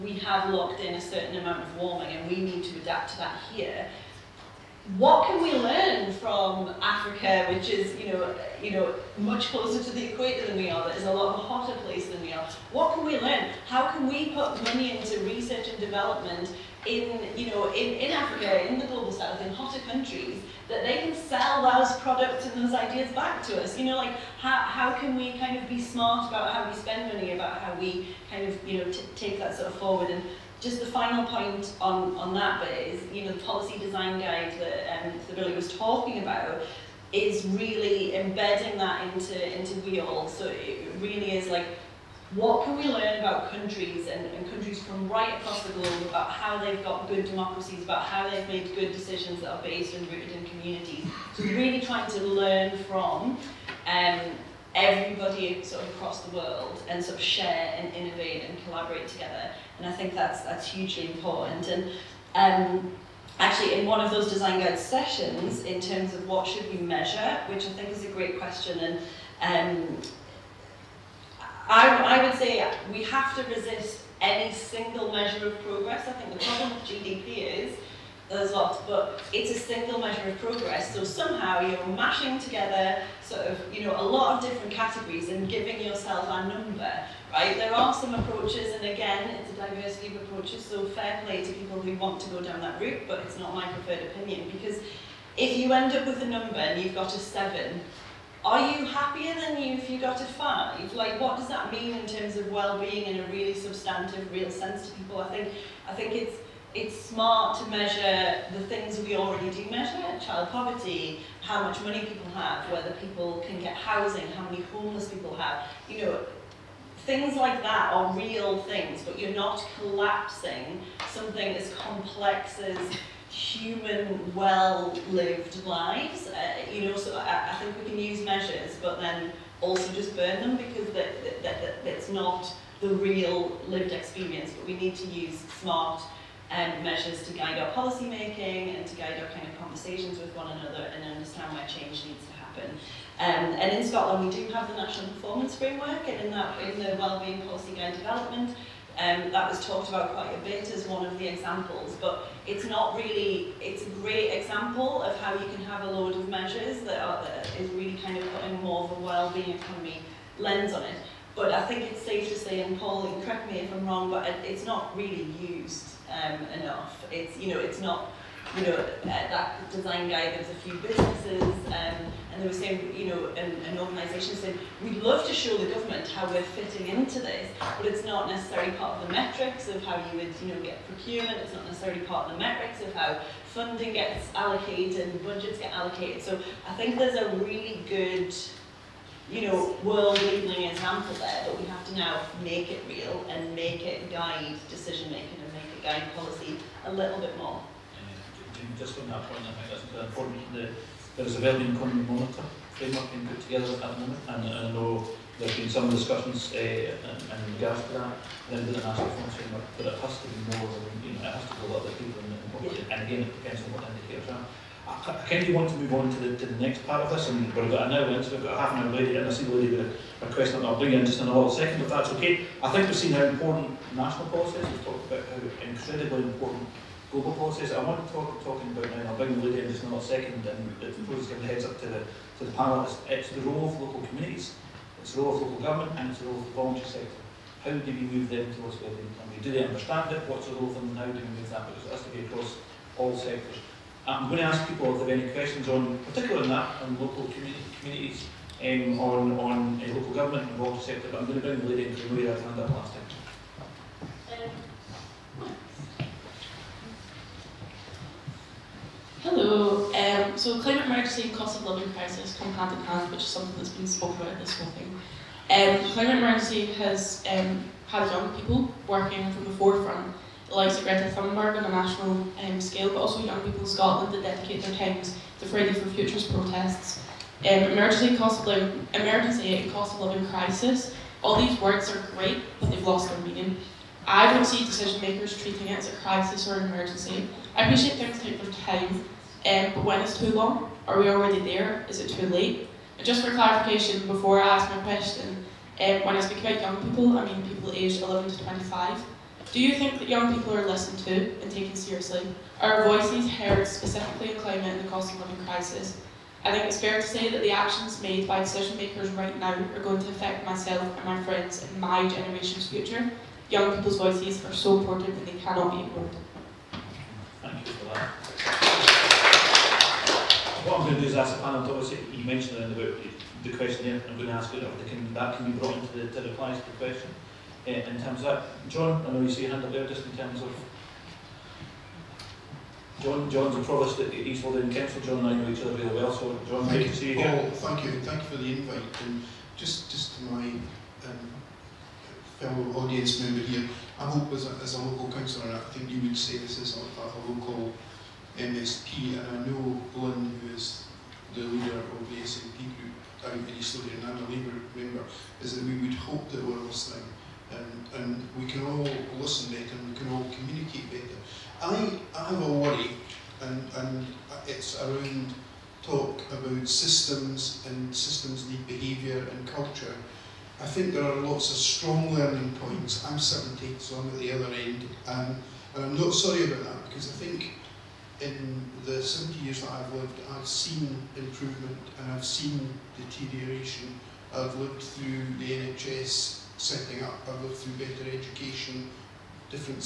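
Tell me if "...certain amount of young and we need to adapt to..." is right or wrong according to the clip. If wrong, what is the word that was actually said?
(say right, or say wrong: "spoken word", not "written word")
wrong: "warming", not "young".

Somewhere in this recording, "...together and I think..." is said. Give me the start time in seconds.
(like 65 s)
59 s.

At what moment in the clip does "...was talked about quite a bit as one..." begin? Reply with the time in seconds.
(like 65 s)
149 s.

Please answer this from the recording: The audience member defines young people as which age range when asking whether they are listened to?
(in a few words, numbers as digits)
11 to 25.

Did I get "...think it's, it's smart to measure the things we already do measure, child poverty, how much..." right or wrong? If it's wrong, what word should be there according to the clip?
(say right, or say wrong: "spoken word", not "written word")
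right.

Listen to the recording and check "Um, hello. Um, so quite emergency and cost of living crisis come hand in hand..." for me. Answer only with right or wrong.
wrong.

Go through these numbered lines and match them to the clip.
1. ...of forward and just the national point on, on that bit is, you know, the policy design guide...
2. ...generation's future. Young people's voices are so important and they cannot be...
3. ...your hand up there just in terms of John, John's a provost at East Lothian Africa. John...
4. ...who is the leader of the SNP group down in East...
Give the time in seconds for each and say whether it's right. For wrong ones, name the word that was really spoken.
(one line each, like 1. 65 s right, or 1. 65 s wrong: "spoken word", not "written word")
1. 29 s wrong: "final", not "national"
2. 312 s right
3. 329 s wrong: "Council", not "Africa"
4. 350 s right.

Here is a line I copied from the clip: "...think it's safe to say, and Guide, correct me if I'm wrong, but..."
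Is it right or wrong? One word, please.
wrong.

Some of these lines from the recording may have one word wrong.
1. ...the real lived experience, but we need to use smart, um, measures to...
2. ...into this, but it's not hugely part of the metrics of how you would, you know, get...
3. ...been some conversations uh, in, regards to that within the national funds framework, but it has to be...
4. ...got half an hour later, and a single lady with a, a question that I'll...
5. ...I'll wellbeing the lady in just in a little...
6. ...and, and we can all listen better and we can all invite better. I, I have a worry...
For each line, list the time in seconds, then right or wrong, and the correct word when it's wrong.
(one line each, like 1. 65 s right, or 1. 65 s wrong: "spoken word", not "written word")
1. 132 s right
2. 176 s wrong: "necessarily", not "hugely"
3. 205 s wrong: "discussions", not "conversations"
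4. 218 s right
5. 229 s wrong: "bring", not "wellbeing"
6. 357 s wrong: "communicate", not "invite".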